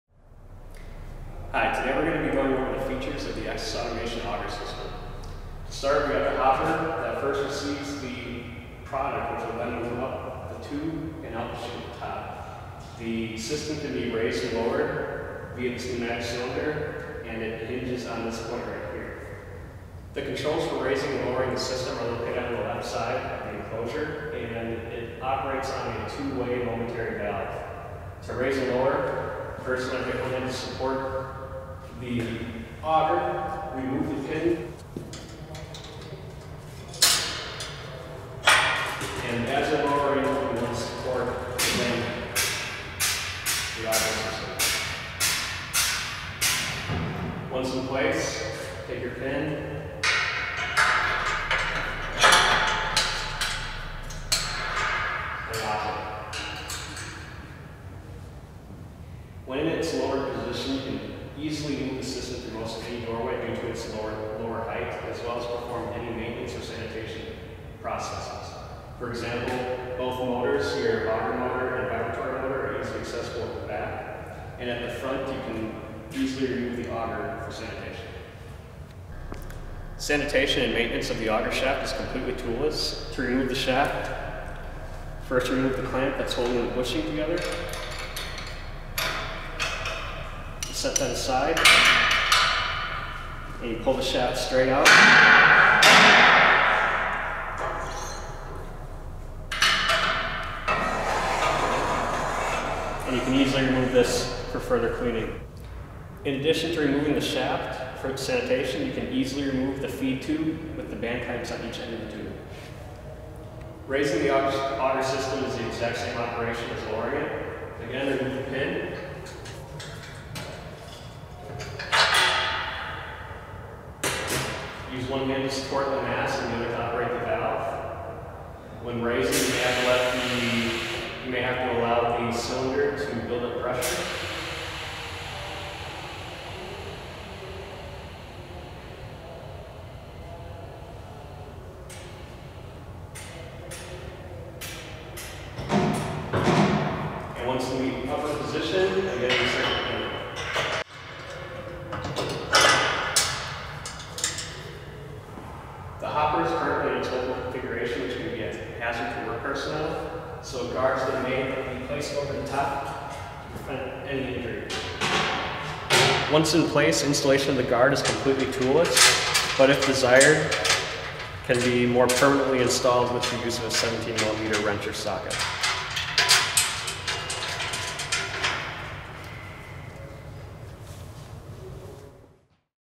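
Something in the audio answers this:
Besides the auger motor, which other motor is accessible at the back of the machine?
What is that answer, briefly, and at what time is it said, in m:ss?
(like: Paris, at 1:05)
vibratory motor, at 1:11.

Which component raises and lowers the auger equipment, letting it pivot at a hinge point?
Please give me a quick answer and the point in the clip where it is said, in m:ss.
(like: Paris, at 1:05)
pneumatic cylinder, at 0:15.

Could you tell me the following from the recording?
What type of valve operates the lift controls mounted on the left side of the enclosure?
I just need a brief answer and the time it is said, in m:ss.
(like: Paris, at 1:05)
two-way momentary valve, at 0:26.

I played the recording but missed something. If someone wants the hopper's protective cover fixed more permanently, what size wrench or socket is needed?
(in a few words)
17 millimeter.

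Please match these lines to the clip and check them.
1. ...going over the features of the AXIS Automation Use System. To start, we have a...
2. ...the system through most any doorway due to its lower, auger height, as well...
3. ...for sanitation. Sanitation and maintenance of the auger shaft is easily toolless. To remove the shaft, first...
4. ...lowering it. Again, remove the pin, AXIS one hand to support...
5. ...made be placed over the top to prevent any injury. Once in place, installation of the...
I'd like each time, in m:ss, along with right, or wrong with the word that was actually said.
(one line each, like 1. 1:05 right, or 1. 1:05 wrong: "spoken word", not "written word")
1. 0:02 wrong: "Auger", not "Use"
2. 1:01 wrong: "lower", not "auger"
3. 1:17 wrong: "completely", not "easily"
4. 1:56 wrong: "Use", not "AXIS"
5. 2:41 right.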